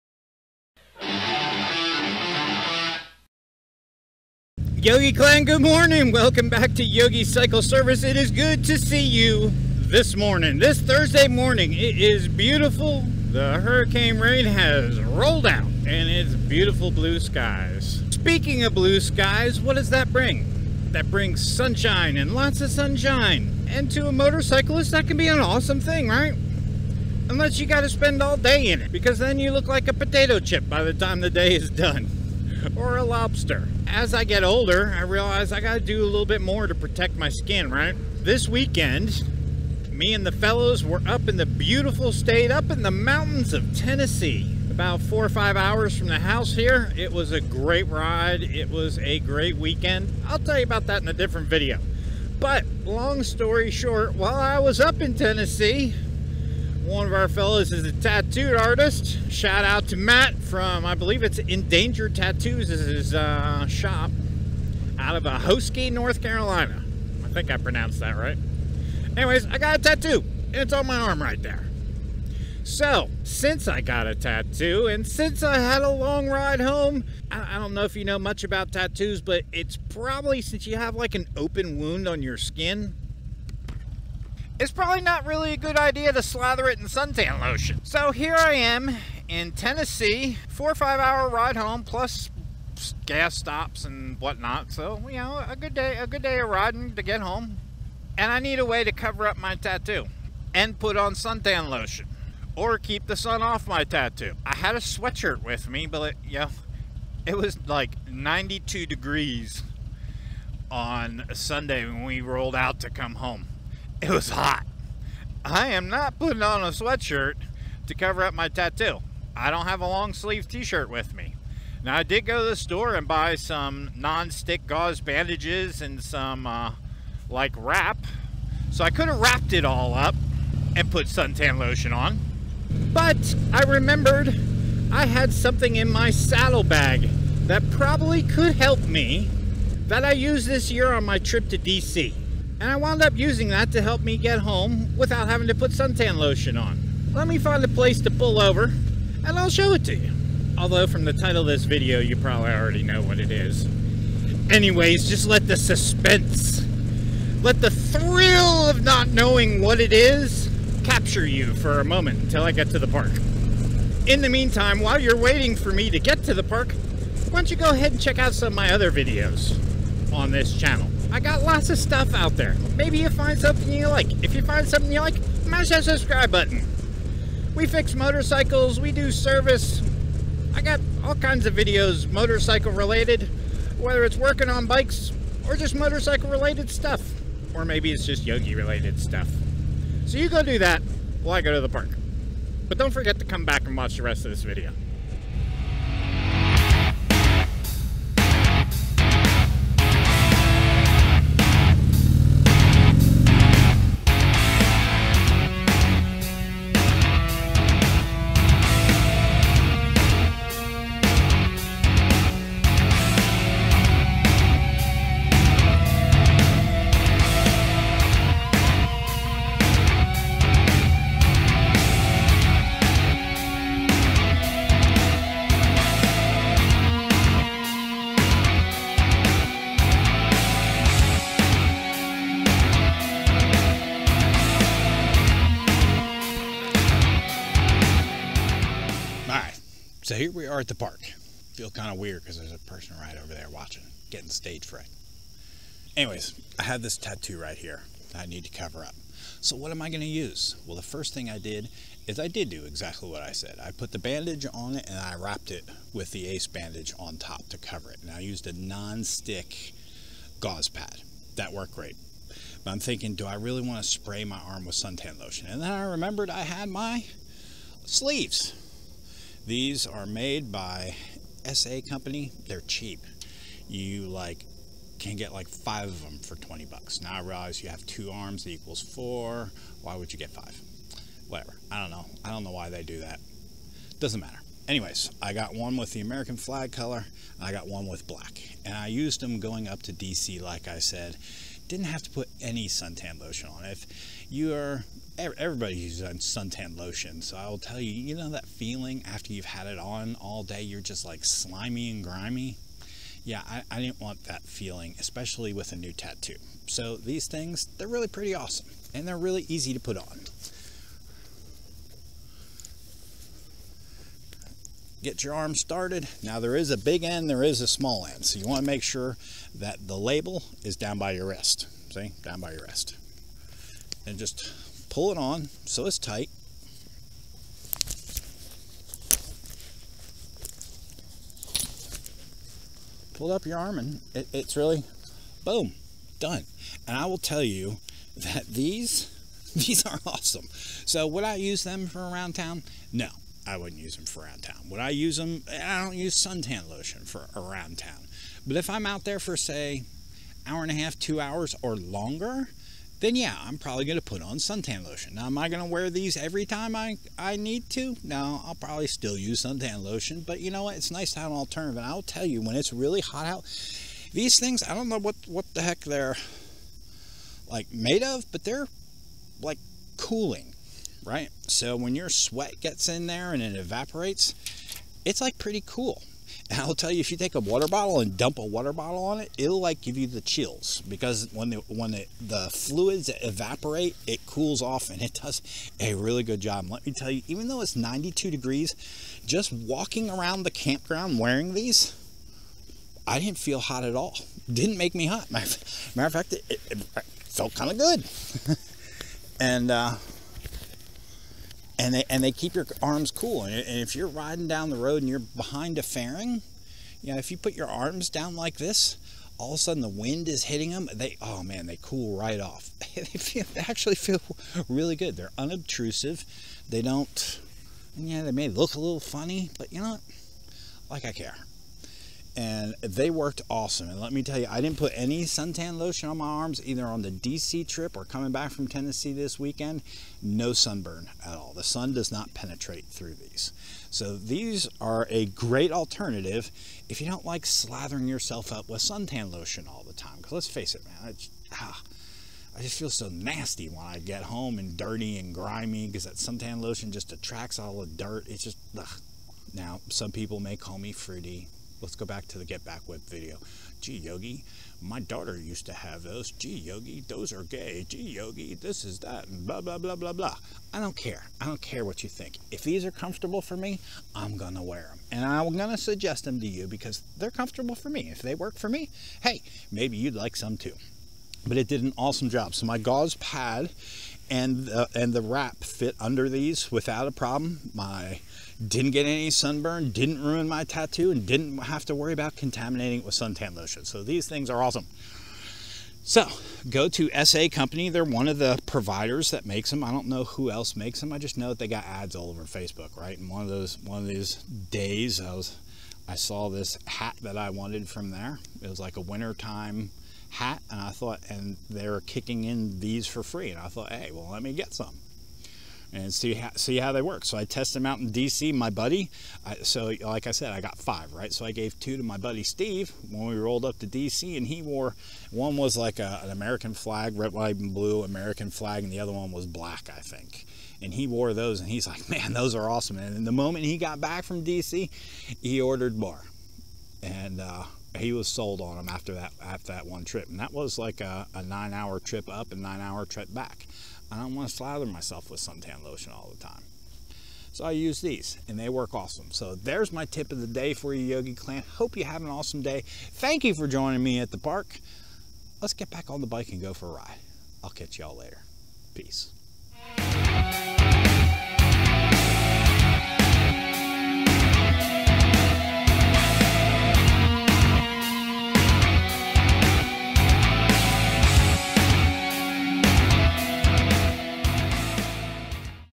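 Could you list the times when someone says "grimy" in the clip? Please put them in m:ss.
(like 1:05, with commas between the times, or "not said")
5:02, 7:25.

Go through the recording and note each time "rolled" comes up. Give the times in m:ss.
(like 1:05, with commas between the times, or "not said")
0:15, 1:52, 8:33.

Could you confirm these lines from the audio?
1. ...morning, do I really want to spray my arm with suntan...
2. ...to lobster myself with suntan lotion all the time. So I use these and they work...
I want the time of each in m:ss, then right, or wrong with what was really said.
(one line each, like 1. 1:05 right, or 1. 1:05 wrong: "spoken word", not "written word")
1. 4:22 wrong: "thinking", not "morning"
2. 8:54 wrong: "slather", not "lobster".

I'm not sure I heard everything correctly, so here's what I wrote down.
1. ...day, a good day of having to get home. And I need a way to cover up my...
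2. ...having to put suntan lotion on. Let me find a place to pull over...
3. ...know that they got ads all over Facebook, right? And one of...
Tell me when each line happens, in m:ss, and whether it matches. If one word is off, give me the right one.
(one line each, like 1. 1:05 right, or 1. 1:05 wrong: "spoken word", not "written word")
1. 1:35 wrong: "riding", not "having"
2. 2:25 right
3. 8:11 right.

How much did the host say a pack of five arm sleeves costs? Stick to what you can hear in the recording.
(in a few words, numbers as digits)
$20.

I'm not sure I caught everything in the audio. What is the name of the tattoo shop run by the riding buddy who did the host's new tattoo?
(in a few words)
Endangered Tattoos.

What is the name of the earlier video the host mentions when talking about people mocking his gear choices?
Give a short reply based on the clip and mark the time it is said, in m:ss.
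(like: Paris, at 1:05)
Get Back Whip, at 7:32.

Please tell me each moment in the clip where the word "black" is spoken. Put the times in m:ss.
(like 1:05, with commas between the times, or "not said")
4:48, 8:39.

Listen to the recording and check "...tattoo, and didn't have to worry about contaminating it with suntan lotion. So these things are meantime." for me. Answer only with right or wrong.
wrong.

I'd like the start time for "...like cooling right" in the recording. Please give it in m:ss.
6:09.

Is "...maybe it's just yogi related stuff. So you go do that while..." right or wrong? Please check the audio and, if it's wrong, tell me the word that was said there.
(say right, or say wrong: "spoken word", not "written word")
right.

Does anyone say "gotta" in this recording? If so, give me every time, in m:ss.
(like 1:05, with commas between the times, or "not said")
0:27, 0:35.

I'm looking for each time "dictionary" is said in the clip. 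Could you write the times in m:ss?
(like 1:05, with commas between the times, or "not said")
not said.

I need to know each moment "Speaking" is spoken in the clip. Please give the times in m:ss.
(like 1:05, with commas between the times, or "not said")
0:18.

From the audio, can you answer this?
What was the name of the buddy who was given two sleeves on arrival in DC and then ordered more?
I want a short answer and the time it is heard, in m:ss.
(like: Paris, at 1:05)
Steve, at 8:32.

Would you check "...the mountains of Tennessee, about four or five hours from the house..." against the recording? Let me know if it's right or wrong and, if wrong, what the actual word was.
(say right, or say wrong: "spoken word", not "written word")
right.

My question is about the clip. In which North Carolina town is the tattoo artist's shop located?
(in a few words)
Ahoskie.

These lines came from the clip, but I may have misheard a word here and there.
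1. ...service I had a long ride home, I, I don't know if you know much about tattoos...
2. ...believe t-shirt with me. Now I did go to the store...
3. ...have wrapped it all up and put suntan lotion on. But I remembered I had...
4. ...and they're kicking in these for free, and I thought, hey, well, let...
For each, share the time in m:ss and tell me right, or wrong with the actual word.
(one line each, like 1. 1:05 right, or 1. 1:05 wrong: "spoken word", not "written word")
1. 1:15 wrong: "since", not "service"
2. 2:00 wrong: "sleeve", not "believe"
3. 2:09 right
4. 8:21 right.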